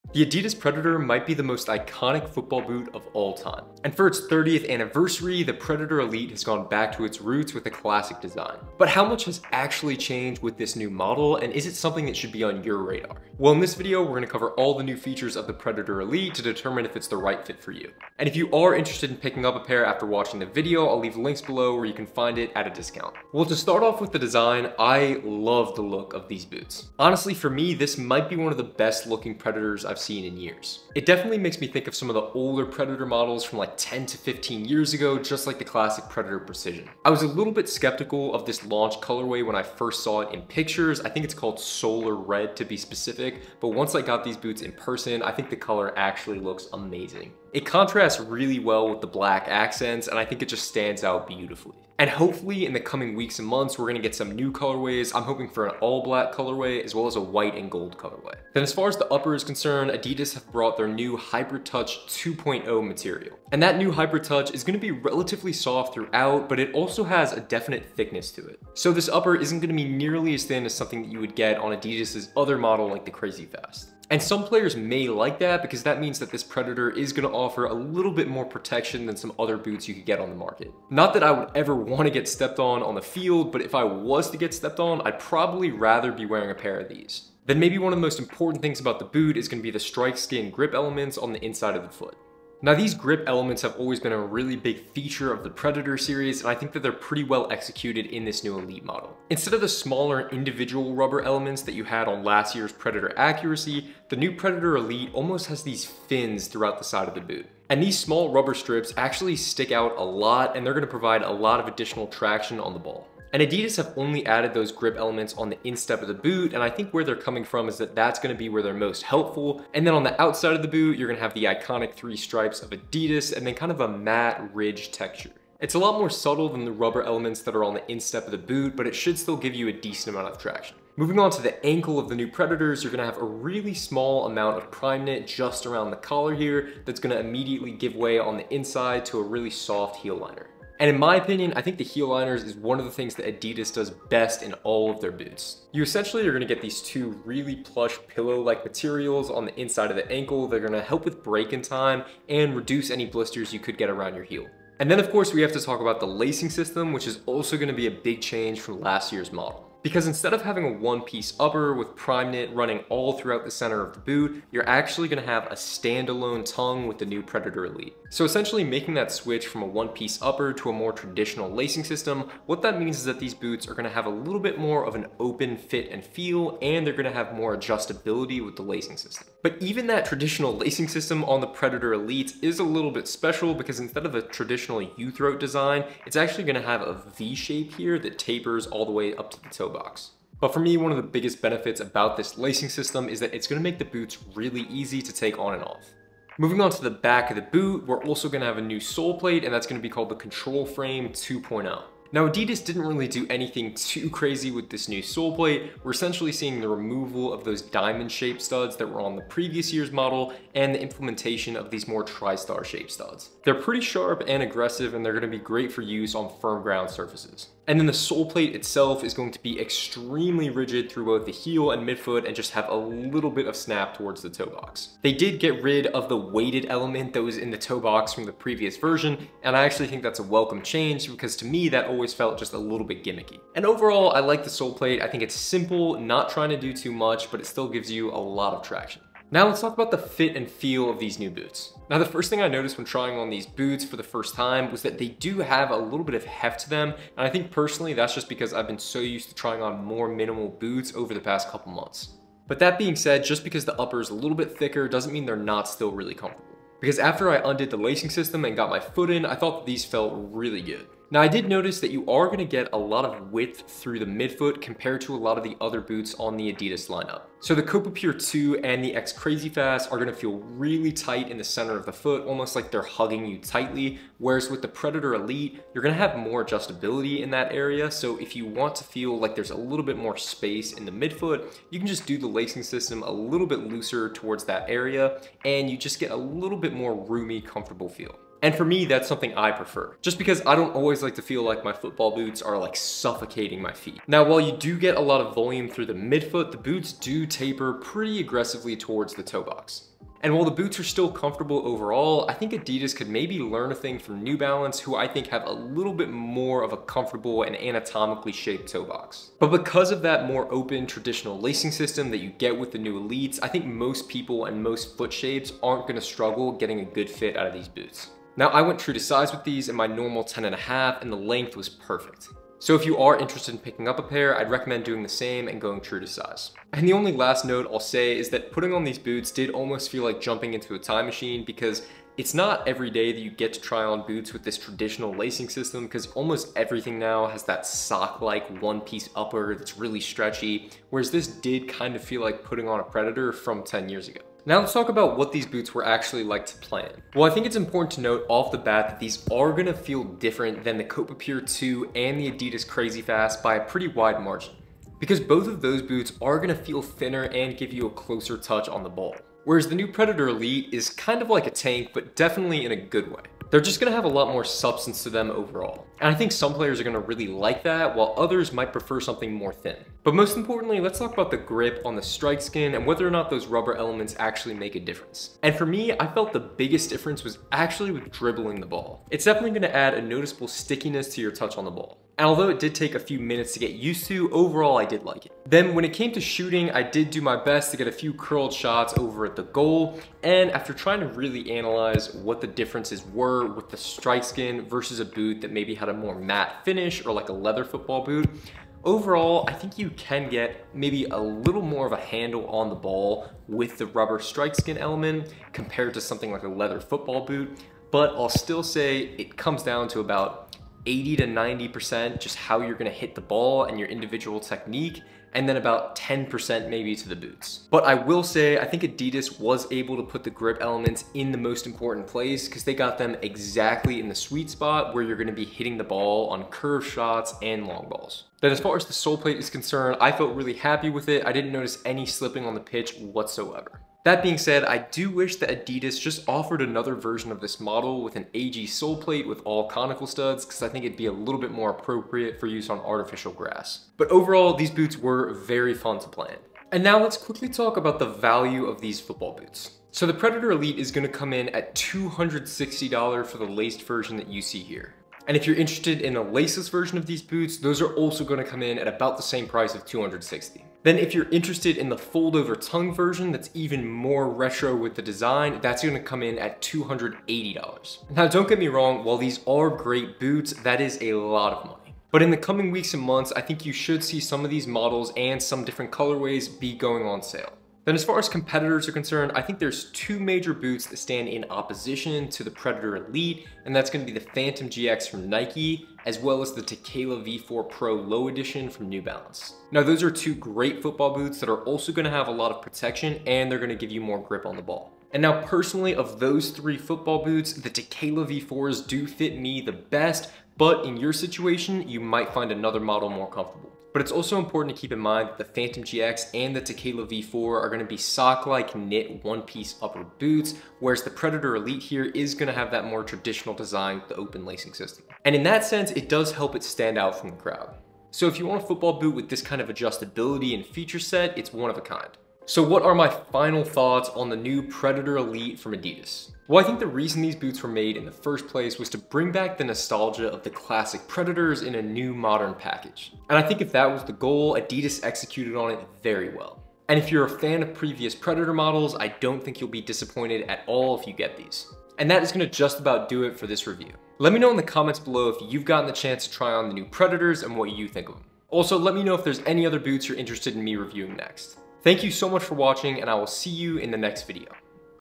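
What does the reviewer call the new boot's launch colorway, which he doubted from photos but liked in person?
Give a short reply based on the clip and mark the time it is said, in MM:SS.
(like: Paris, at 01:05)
Solar Red, at 00:41.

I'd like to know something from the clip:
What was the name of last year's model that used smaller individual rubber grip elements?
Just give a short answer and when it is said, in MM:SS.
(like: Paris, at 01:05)
Predator Accuracy, at 01:42.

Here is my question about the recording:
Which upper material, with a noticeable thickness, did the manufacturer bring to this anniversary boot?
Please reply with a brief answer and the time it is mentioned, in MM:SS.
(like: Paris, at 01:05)
Hyper Touch 2.0, at 01:01.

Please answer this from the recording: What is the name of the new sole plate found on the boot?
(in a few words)
Control Frame 2.0.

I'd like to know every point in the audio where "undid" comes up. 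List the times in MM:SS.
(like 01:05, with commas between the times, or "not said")
04:17.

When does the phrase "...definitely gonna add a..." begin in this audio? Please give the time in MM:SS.
06:19.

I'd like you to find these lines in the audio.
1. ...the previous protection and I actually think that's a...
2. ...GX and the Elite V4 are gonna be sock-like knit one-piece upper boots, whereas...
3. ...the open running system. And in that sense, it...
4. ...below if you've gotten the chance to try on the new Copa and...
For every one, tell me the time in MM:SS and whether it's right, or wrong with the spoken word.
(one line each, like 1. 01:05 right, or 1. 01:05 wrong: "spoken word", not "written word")
1. 03:48 wrong: "version", not "protection"
2. 08:25 wrong: "Tekela", not "Elite"
3. 08:34 wrong: "lacing", not "running"
4. 09:04 wrong: "Predators", not "Copa".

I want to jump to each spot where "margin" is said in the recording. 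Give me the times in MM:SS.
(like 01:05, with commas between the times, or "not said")
05:54.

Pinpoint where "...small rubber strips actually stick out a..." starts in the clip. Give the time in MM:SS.
01:47.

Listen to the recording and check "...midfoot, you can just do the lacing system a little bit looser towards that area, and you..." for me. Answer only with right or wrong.
right.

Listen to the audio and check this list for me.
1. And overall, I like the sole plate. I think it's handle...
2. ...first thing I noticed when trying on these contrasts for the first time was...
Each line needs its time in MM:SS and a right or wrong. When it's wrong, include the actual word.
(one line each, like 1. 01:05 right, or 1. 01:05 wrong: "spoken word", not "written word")
1. 03:53 wrong: "simple", not "handle"
2. 04:02 wrong: "boots", not "contrasts".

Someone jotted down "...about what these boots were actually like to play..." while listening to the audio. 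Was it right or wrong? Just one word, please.
right.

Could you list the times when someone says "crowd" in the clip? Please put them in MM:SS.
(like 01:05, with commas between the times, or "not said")
08:37.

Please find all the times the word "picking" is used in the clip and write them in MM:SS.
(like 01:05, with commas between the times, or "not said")
00:19, 05:23.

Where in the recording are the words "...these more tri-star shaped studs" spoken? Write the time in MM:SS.
03:31.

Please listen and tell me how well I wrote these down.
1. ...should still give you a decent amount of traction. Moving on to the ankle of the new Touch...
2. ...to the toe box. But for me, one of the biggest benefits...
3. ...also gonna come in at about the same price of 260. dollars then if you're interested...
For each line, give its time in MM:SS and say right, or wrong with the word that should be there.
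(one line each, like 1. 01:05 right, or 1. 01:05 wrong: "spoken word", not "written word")
1. 02:08 wrong: "Predators", not "Touch"
2. 03:09 right
3. 07:37 right.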